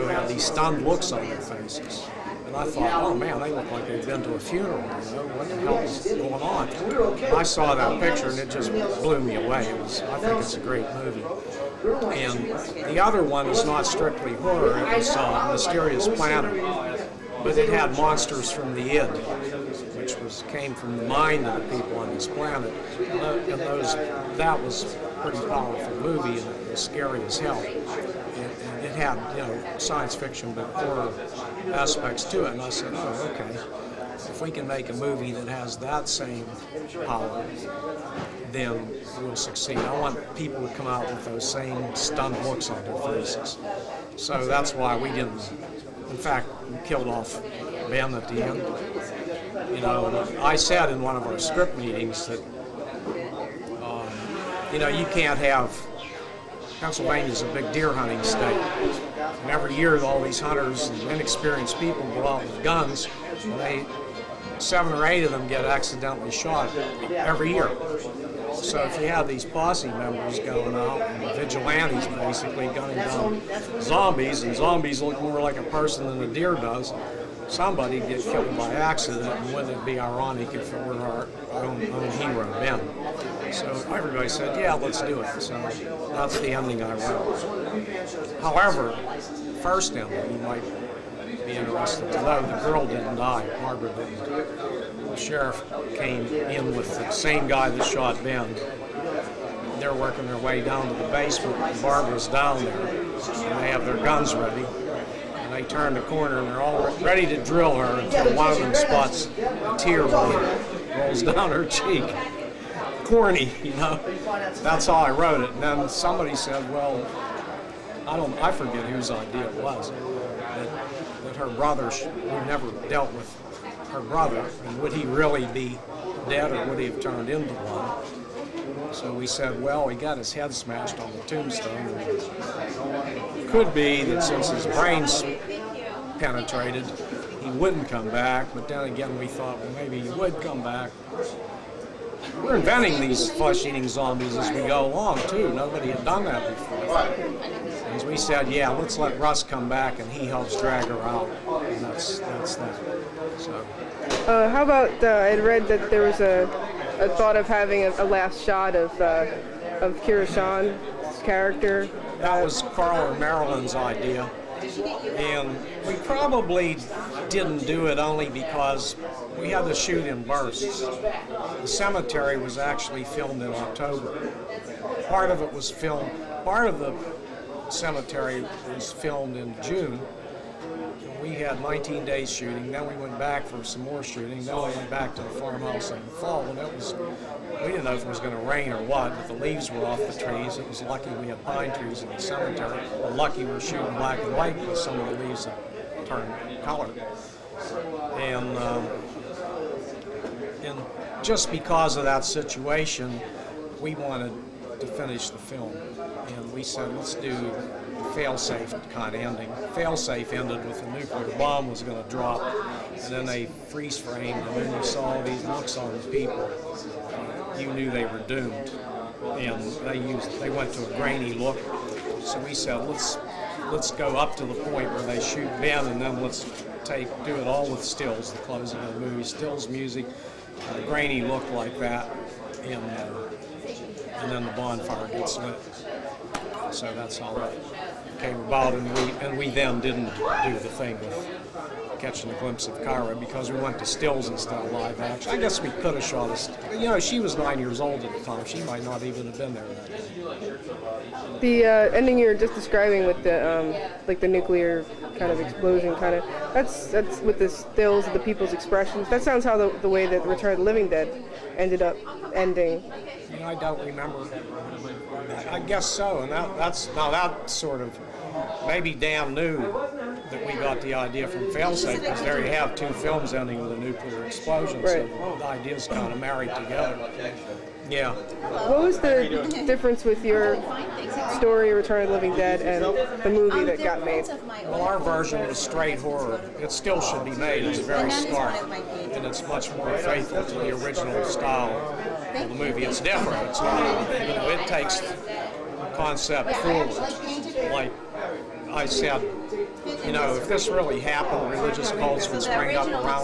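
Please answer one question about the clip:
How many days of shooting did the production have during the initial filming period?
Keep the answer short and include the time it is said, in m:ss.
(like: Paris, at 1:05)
19, at 3:01.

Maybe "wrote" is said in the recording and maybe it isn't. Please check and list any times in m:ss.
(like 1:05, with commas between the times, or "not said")
1:26, 1:55.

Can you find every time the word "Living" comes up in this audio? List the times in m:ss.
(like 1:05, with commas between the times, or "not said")
4:20, 4:42.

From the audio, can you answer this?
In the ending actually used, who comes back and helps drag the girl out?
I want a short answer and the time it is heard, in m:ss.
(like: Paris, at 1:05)
Russ, at 2:29.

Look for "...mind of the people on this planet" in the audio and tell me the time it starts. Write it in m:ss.
0:21.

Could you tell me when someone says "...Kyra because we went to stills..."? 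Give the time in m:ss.
4:02.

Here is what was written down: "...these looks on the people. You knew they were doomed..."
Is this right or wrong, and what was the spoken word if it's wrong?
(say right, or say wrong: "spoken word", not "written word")
right.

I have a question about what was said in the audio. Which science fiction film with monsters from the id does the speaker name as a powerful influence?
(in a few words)
Mysterious Planet.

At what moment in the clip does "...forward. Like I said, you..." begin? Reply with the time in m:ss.
4:56.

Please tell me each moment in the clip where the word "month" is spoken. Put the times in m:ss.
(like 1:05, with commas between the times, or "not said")
not said.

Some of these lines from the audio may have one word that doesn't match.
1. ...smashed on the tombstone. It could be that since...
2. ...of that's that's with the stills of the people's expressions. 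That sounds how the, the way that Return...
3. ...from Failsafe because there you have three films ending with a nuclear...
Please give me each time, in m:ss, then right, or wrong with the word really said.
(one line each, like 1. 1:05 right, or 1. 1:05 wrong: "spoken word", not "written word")
1. 2:10 right
2. 4:16 right
3. 4:31 wrong: "two", not "three".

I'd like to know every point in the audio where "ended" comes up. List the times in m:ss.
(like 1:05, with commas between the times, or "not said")
3:30, 4:21.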